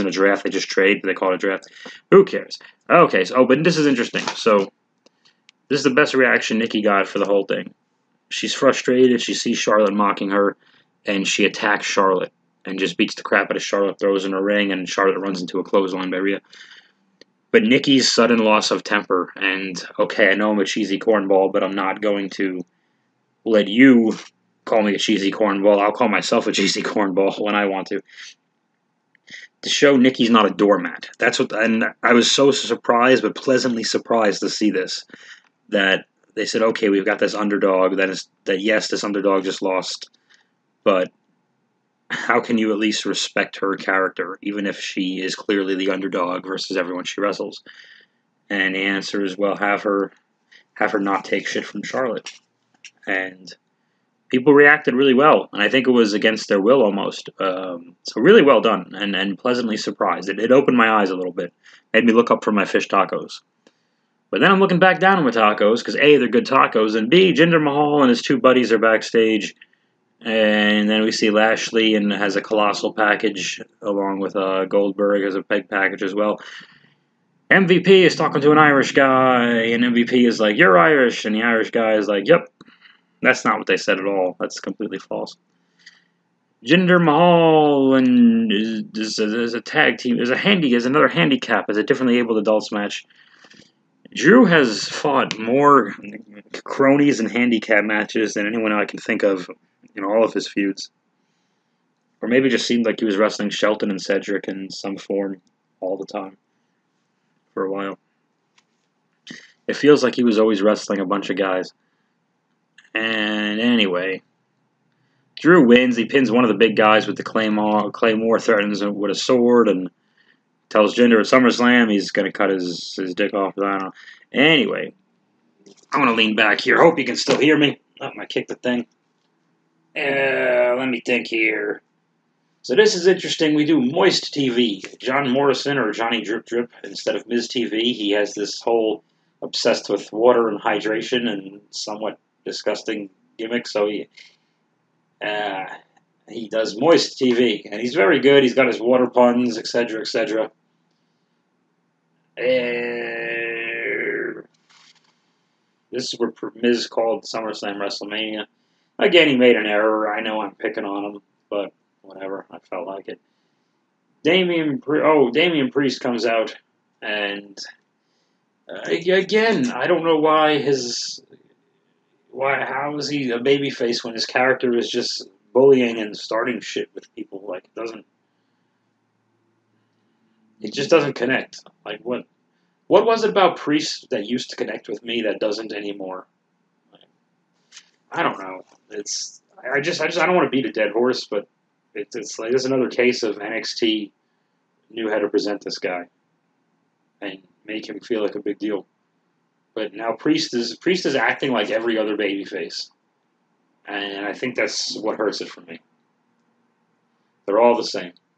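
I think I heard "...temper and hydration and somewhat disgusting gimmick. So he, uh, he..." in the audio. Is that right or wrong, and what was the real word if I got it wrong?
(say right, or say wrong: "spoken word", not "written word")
wrong: "water", not "temper".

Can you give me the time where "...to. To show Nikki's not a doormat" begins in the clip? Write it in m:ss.
0:27.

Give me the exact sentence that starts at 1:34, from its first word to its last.
Drew has fought more cronies and handicap matches than anyone I can think of in all of his feuds.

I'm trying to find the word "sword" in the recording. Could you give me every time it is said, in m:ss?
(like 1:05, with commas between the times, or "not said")
1:59.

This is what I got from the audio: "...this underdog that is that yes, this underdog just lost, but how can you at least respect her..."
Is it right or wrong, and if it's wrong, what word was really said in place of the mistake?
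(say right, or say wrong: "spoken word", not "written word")
right.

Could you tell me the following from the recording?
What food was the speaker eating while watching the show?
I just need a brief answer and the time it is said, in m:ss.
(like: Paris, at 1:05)
fish tacos, at 1:02.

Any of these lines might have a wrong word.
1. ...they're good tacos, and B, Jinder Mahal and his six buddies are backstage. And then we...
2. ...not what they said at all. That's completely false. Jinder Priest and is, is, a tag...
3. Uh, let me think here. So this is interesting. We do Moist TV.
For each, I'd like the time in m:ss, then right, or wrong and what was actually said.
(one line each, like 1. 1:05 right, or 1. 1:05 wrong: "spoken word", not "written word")
1. 1:06 wrong: "two", not "six"
2. 1:23 wrong: "Mahal", not "Priest"
3. 2:09 right.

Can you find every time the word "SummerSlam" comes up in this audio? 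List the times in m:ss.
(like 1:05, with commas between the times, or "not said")
2:01, 2:37.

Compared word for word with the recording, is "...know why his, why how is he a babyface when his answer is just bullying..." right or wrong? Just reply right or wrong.
wrong.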